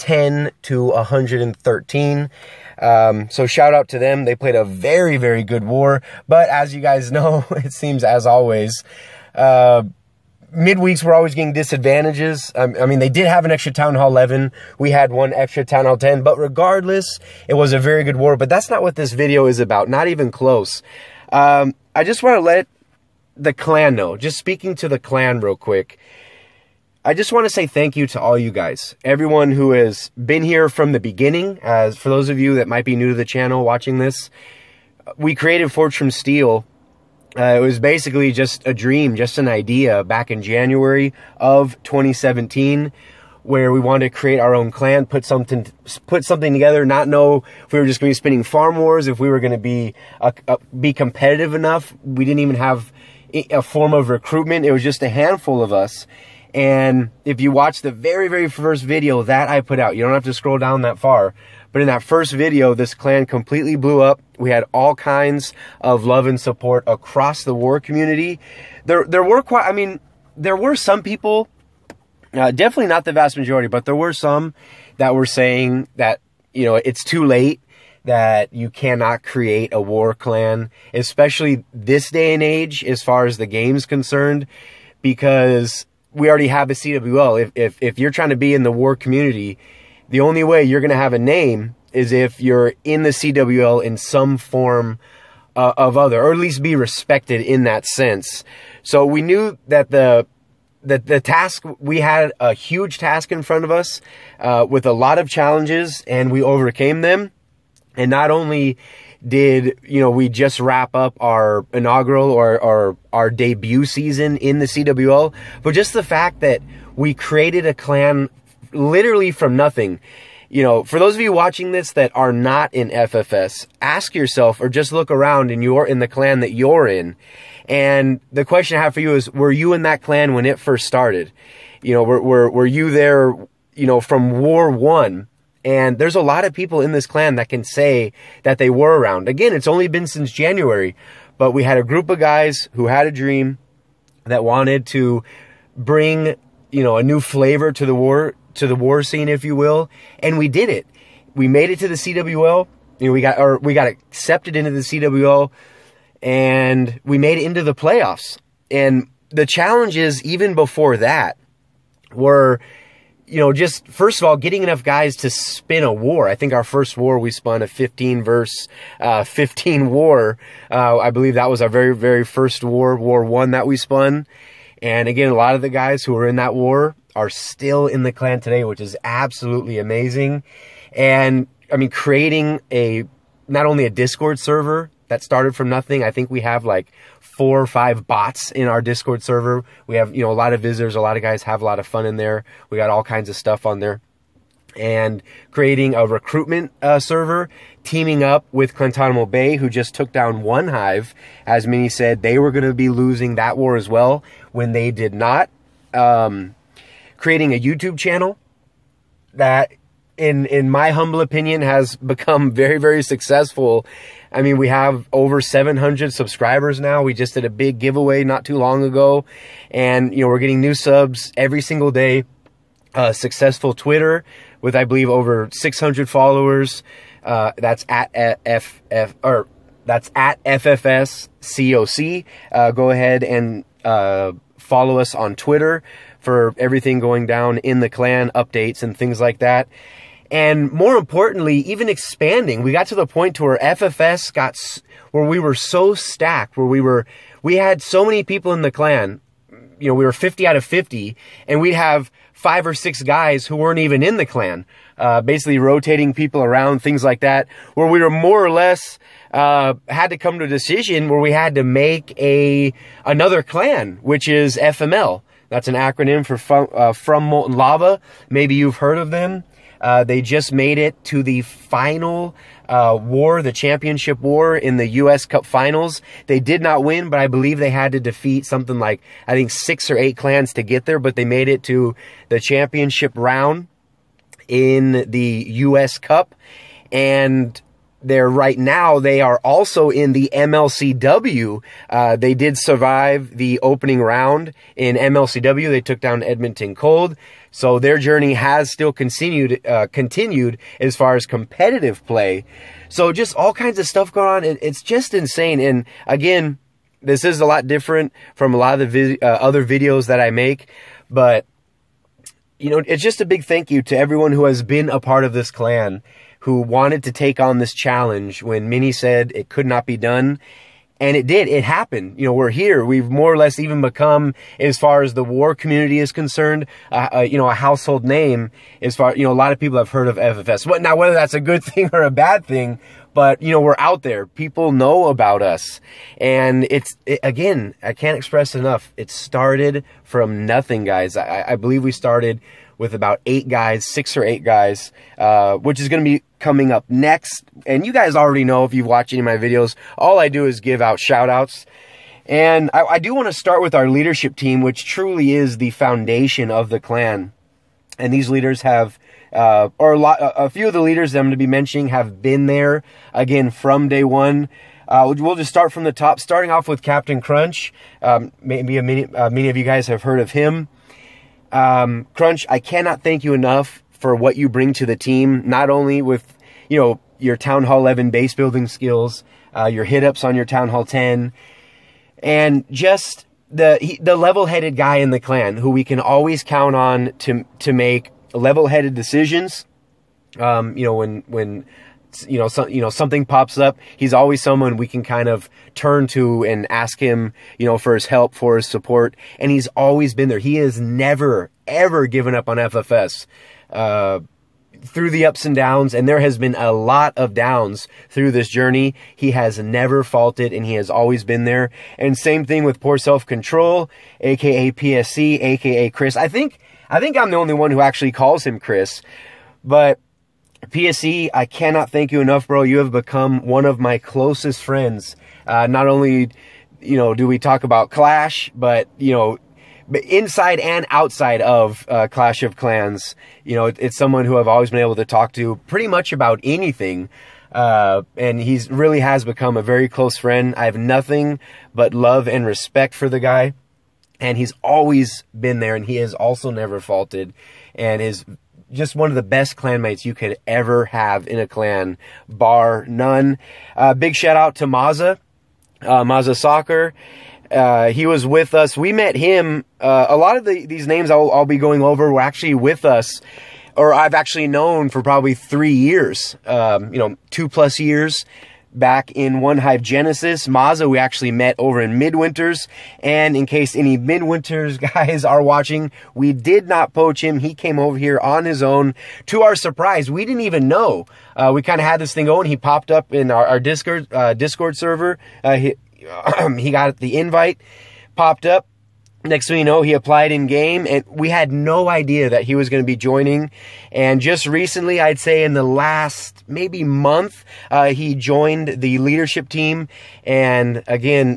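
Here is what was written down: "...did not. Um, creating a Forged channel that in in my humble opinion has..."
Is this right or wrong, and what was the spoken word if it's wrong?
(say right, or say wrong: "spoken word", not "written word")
wrong: "YouTube", not "Forged".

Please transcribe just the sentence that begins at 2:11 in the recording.
You know, were, were, were you there, you know, from war one?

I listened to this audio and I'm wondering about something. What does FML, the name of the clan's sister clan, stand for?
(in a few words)
From Molten Lava.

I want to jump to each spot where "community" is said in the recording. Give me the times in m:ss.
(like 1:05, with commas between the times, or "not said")
1:07, 1:28, 5:25.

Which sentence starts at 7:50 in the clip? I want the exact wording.
Mazza, we actually met over in Midwinters.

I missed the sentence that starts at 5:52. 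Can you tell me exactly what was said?
And I, I do want to start with our leadership team, which truly is the foundation of the clan.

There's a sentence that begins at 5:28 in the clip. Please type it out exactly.
As far, you know, a lot of people have heard of FFS.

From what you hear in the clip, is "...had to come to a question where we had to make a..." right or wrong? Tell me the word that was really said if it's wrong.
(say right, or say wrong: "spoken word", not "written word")
wrong: "decision", not "question".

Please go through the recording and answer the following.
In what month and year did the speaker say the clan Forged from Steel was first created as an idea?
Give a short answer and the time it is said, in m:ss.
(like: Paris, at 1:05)
January 2017, at 0:40.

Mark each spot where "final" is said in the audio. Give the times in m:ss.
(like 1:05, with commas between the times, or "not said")
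4:31, 4:35.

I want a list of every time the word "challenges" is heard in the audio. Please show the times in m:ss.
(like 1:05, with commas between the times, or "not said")
1:45, 2:39, 5:17.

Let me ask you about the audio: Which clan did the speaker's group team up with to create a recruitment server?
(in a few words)
Clantanemo Bay.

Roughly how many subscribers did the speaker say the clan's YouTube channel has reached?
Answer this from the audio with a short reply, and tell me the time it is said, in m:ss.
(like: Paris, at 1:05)
Over 700, at 3:35.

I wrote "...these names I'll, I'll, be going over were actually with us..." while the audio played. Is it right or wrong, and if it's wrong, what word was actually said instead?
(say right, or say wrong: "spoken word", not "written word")
right.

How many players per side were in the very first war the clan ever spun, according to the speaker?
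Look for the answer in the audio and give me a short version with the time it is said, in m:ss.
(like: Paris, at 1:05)
15, at 2:47.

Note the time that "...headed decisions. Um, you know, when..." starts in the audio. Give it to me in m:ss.
6:28.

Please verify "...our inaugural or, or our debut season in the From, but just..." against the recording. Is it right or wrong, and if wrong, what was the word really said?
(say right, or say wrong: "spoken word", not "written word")
wrong: "CWL", not "From".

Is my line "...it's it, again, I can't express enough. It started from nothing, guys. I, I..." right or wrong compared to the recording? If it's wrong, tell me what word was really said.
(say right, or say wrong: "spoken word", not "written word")
right.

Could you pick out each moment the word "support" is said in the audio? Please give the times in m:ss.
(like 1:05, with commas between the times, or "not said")
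1:06, 6:38.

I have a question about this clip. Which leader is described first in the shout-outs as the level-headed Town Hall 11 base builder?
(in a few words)
Captain Crunch.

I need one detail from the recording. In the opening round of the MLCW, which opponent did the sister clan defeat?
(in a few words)
Edmonton Cold.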